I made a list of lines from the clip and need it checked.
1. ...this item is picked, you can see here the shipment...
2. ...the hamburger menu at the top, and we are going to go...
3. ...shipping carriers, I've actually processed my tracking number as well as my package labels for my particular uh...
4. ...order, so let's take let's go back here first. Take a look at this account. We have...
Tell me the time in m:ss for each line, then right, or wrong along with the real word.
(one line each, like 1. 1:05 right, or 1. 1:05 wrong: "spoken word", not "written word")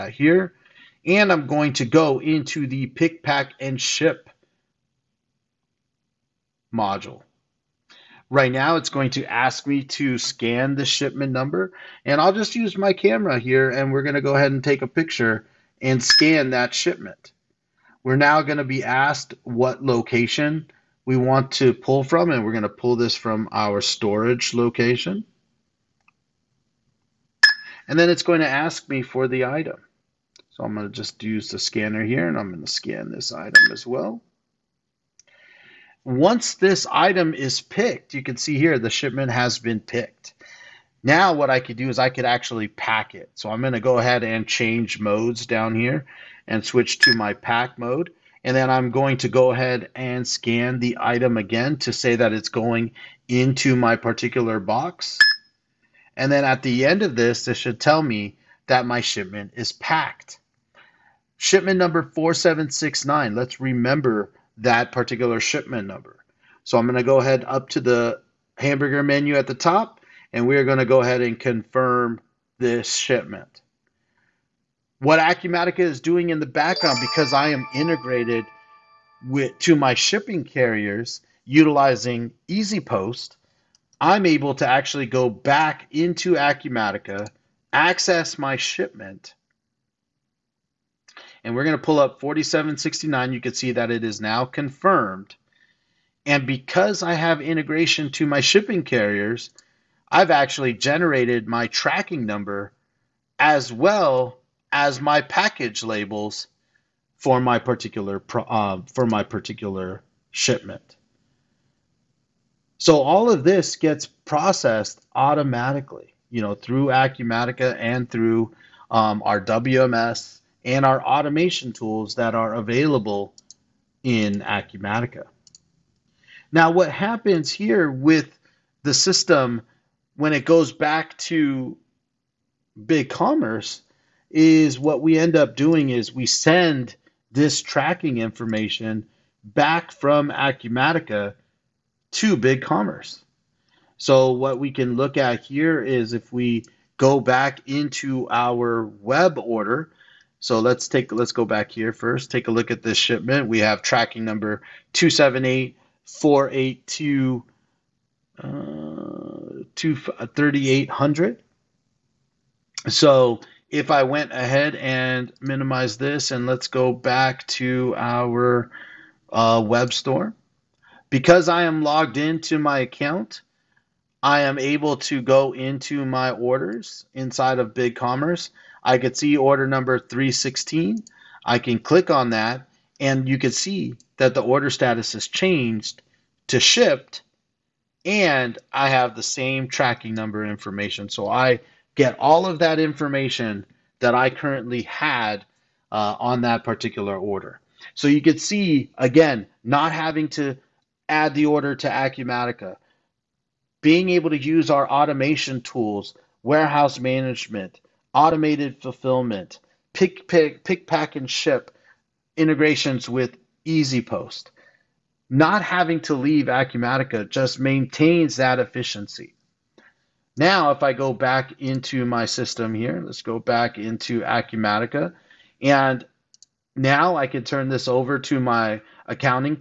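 1. 0:36 right
2. 1:07 right
3. 1:38 wrong: "generated", not "processed"
4. 2:29 wrong: "shipment", not "account".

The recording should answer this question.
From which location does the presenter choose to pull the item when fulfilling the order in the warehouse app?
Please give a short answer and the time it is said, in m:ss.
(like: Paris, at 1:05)
storage location, at 0:23.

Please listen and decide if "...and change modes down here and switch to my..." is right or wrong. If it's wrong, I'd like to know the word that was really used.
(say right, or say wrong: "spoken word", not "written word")
right.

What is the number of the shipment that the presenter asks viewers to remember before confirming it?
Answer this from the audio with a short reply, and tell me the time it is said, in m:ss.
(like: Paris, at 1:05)
4769, at 1:01.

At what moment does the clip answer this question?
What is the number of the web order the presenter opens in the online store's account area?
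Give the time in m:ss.
2:59.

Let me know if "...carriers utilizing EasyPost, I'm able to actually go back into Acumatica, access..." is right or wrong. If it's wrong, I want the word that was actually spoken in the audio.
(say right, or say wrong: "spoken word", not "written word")
right.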